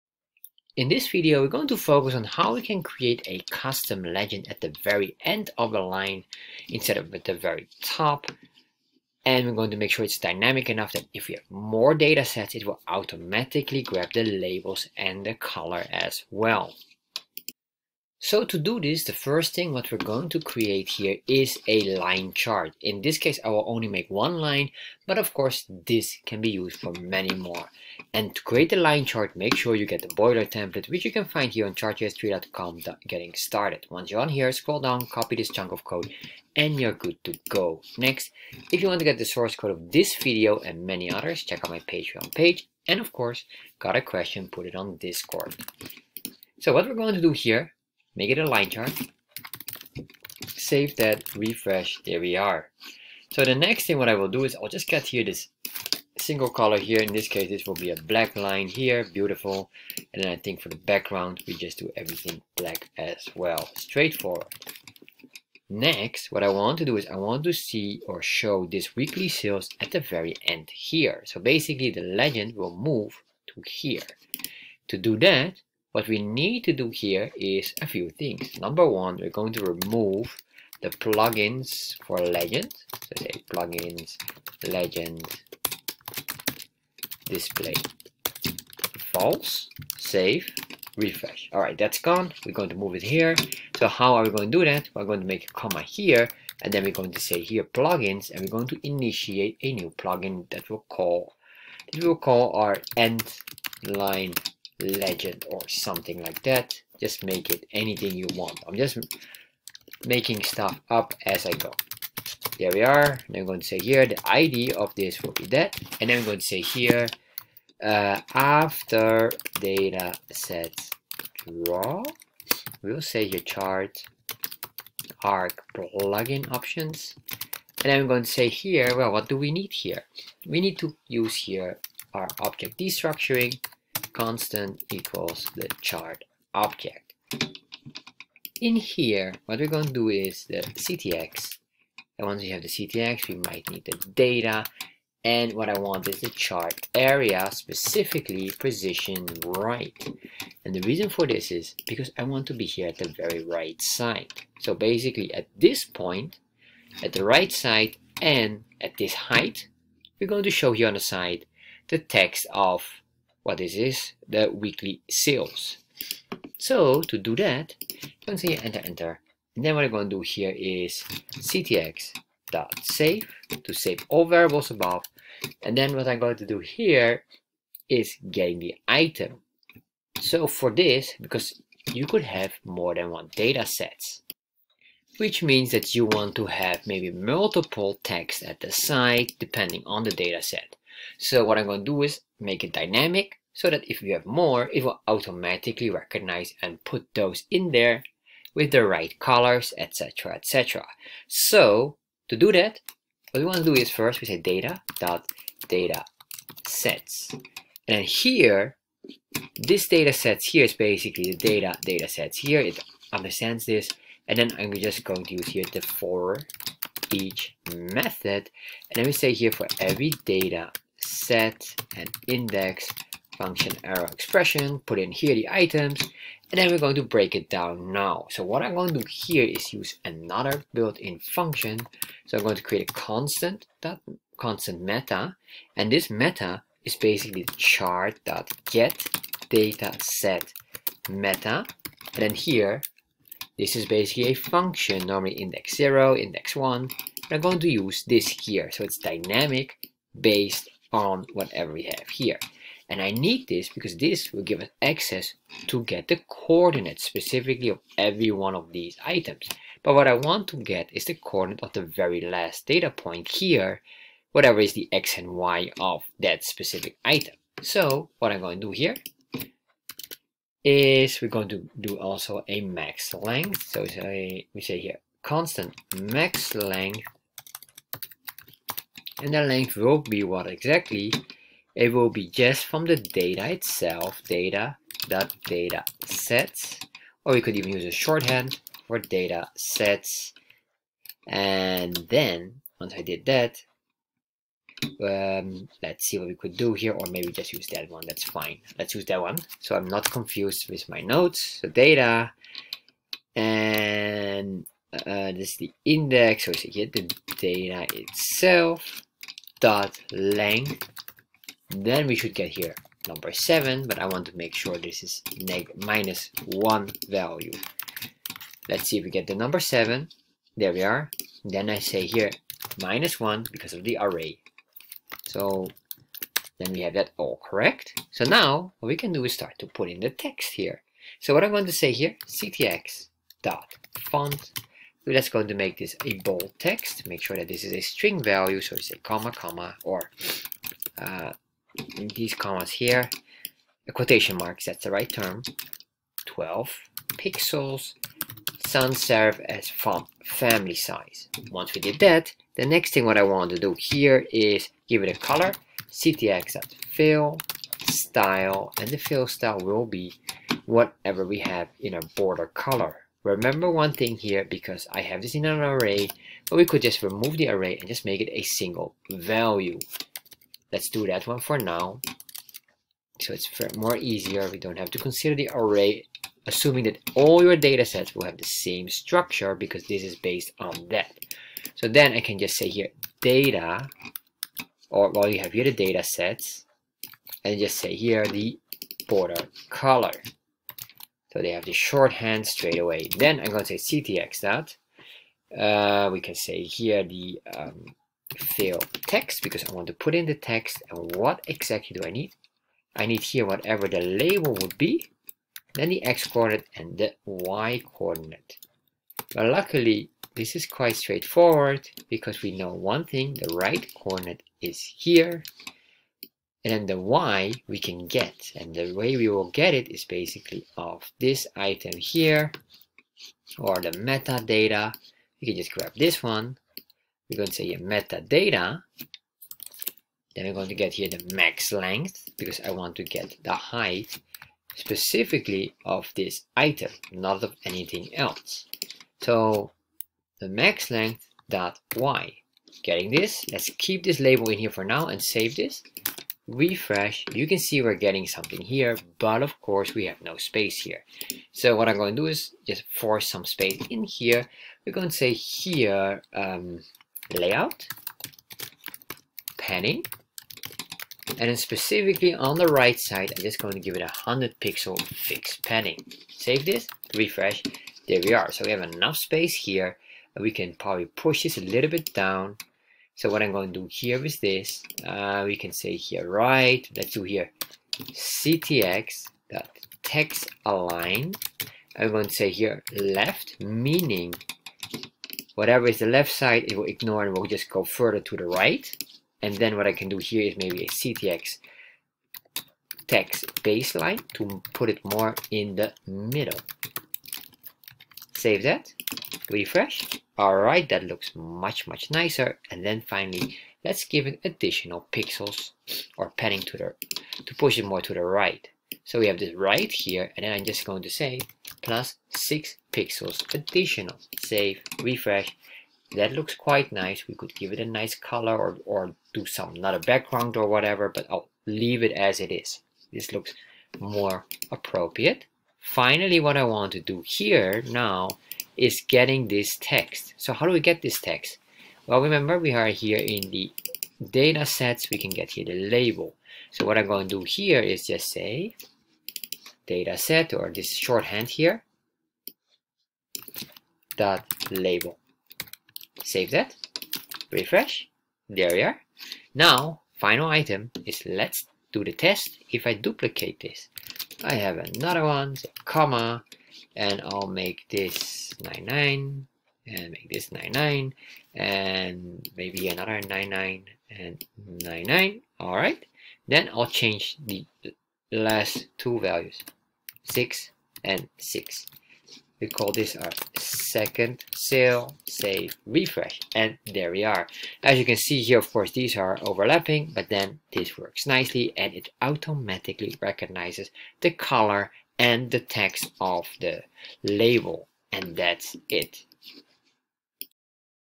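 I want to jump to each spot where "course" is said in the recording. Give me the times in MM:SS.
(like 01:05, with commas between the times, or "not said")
00:25, 00:43, 07:29, 09:38.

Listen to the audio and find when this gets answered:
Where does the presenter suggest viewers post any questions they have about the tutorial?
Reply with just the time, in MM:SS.
00:44.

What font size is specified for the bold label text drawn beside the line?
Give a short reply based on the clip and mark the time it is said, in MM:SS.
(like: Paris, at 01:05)
12 pixels, at 05:46.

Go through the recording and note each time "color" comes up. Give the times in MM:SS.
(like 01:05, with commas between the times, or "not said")
00:15, 00:56, 03:19, 05:55, 06:02, 06:29, 08:38, 09:44.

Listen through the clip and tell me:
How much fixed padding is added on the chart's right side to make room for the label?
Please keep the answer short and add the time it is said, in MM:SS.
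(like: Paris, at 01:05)
100 pixels, at 07:44.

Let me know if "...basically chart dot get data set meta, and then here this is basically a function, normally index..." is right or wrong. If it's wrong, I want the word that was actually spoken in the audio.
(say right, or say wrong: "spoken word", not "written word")
right.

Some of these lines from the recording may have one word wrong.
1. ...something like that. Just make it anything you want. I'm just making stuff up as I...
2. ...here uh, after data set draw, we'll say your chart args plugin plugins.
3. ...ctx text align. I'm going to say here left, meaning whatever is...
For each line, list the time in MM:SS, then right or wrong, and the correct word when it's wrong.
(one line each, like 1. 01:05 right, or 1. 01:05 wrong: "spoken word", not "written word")
1. 01:45 right
2. 01:56 wrong: "options", not "plugins"
3. 07:57 right.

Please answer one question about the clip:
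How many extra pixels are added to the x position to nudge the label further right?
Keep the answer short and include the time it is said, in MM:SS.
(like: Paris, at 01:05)
6 pixels, at 08:32.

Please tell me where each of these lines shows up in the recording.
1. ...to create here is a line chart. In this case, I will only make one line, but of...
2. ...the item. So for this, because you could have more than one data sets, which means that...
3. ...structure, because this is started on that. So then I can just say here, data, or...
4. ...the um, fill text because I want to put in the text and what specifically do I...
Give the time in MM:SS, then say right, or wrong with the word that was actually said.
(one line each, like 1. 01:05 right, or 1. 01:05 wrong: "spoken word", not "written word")
1. 00:20 right
2. 02:58 right
3. 06:18 wrong: "based", not "started"
4. 06:37 wrong: "exactly", not "specifically".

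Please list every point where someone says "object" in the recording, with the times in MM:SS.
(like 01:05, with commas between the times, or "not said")
02:12, 02:16.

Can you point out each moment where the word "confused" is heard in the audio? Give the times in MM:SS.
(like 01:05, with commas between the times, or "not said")
05:00.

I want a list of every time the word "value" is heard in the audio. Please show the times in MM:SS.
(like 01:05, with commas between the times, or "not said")
05:17, 05:38, 06:09, 09:29.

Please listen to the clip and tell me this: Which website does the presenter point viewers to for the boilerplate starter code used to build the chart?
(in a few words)
chartjs3.com.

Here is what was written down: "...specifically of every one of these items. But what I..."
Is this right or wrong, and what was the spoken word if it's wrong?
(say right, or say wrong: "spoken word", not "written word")
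right.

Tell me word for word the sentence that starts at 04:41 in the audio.
It will be just from the data itself, data dot data sets, or you could even use a shorthand for data sets.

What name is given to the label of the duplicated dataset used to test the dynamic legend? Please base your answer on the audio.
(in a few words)
second sale.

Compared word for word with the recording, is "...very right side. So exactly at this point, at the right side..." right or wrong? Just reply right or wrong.
wrong.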